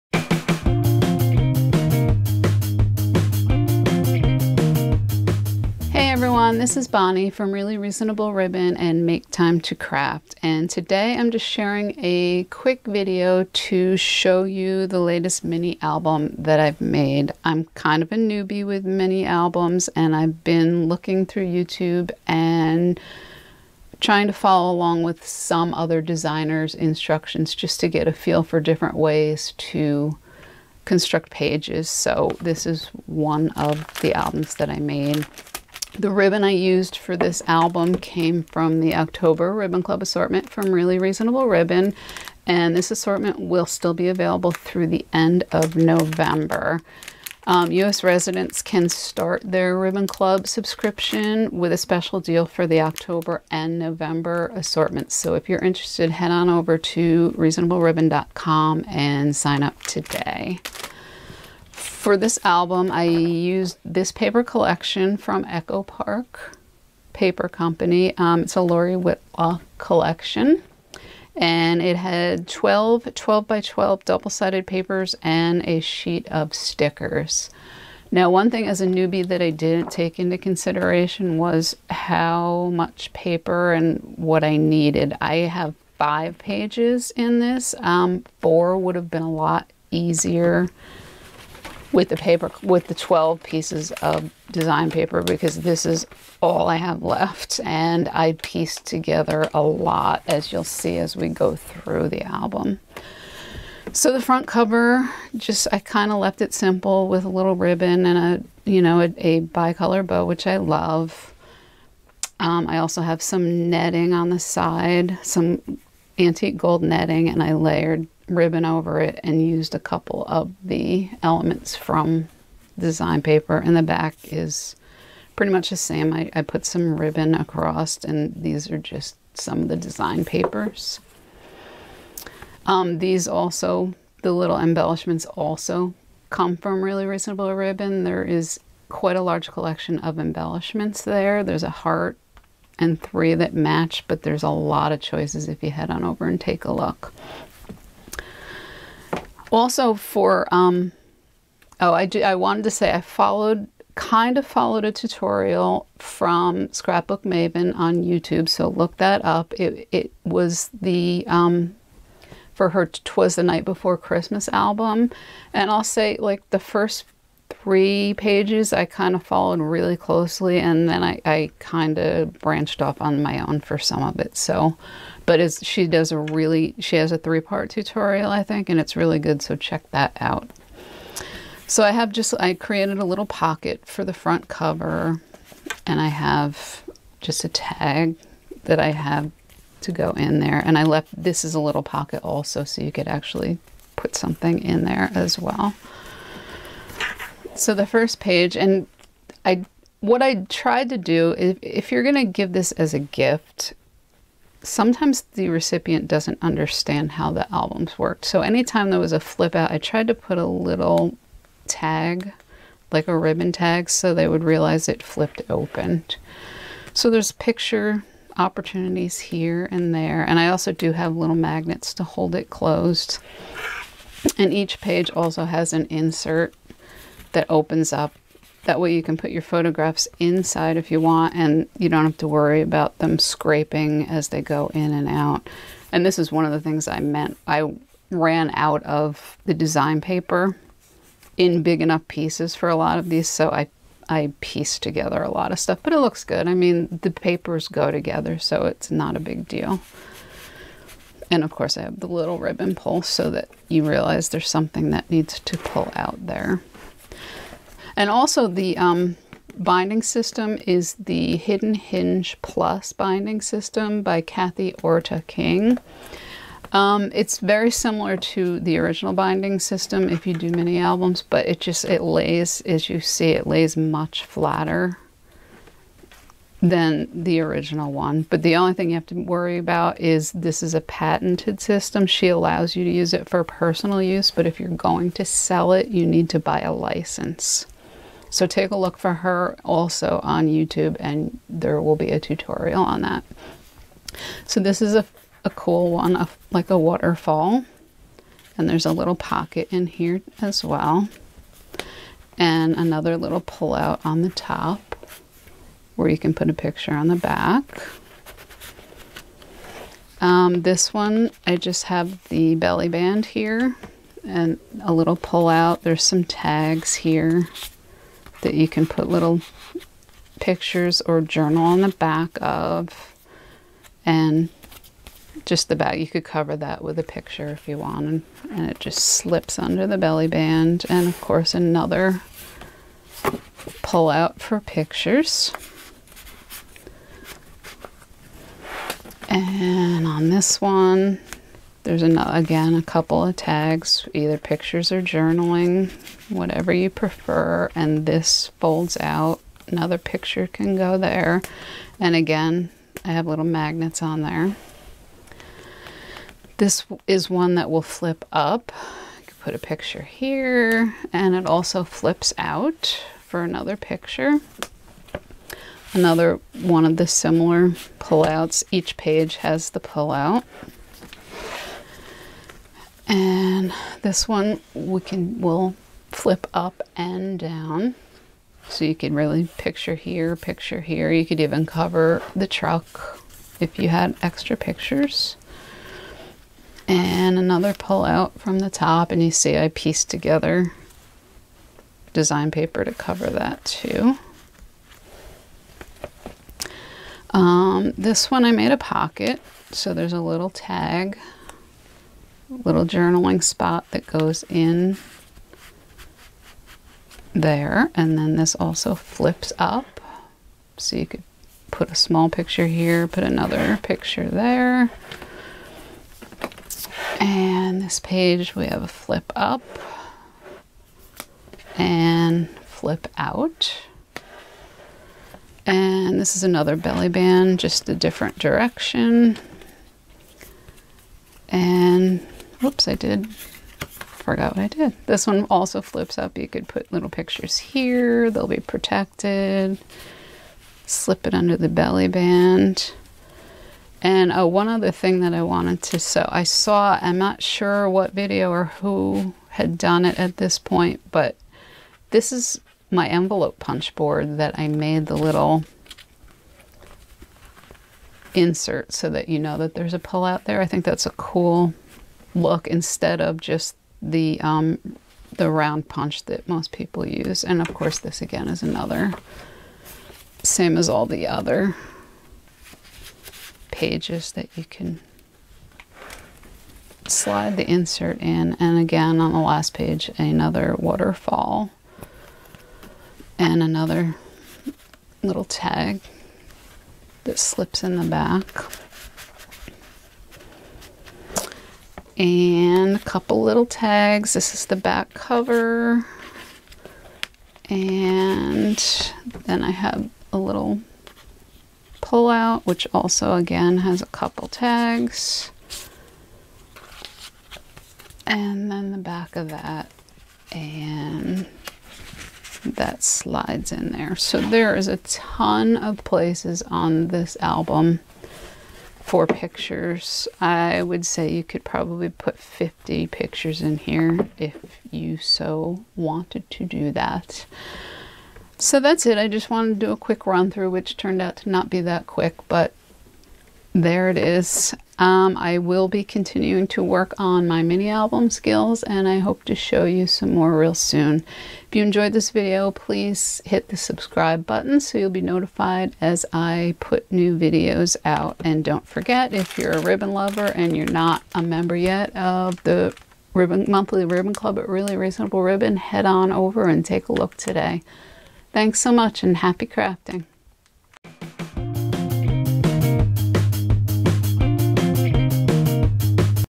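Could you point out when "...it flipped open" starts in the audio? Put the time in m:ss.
3:34.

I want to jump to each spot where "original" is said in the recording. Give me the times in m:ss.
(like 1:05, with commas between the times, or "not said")
4:28, 4:37.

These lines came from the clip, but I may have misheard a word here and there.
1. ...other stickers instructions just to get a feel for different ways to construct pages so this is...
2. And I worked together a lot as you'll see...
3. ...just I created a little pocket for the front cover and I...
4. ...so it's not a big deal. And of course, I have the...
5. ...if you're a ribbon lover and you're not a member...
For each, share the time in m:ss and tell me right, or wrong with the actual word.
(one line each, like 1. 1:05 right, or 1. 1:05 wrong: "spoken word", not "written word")
1. 0:25 wrong: "designers", not "stickers"
2. 1:37 wrong: "pieced", not "worked"
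3. 3:02 right
4. 4:08 right
5. 9:09 right.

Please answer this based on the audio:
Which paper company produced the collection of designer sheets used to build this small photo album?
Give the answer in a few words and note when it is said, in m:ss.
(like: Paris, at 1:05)
Echo Park Paper Company, at 1:05.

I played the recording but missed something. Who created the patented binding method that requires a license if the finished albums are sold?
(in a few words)
Kathy Orta King.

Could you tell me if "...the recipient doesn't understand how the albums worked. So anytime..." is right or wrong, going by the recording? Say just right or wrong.
right.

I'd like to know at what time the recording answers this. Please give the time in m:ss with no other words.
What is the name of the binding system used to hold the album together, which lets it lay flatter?
4:21.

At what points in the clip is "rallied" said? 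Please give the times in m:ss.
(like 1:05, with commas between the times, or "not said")
not said.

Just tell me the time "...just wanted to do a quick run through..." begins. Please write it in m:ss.
8:49.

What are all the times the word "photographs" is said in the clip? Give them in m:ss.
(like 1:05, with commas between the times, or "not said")
3:49.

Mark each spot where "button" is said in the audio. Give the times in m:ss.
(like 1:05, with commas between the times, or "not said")
9:04.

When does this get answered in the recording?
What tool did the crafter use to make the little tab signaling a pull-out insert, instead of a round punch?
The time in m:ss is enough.
7:33.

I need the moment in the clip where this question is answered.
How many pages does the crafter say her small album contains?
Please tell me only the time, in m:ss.
1:25.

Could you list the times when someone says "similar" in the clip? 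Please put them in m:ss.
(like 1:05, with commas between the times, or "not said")
4:27, 6:07.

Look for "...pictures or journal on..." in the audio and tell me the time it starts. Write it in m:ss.
5:20.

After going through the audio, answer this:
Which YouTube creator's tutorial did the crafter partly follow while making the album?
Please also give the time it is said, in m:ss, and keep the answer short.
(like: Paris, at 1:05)
Scrapbook Maven, at 2:36.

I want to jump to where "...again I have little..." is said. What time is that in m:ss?
5:52.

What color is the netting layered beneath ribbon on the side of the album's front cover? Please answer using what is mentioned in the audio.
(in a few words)
antique gold.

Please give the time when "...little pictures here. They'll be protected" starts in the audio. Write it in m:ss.
7:16.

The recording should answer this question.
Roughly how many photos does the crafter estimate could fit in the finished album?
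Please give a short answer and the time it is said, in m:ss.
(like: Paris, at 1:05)
50, at 8:42.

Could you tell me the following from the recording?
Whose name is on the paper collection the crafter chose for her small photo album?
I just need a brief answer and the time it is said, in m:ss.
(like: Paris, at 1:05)
Lori Whitlock, at 1:08.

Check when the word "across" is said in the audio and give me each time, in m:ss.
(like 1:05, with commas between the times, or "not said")
2:07.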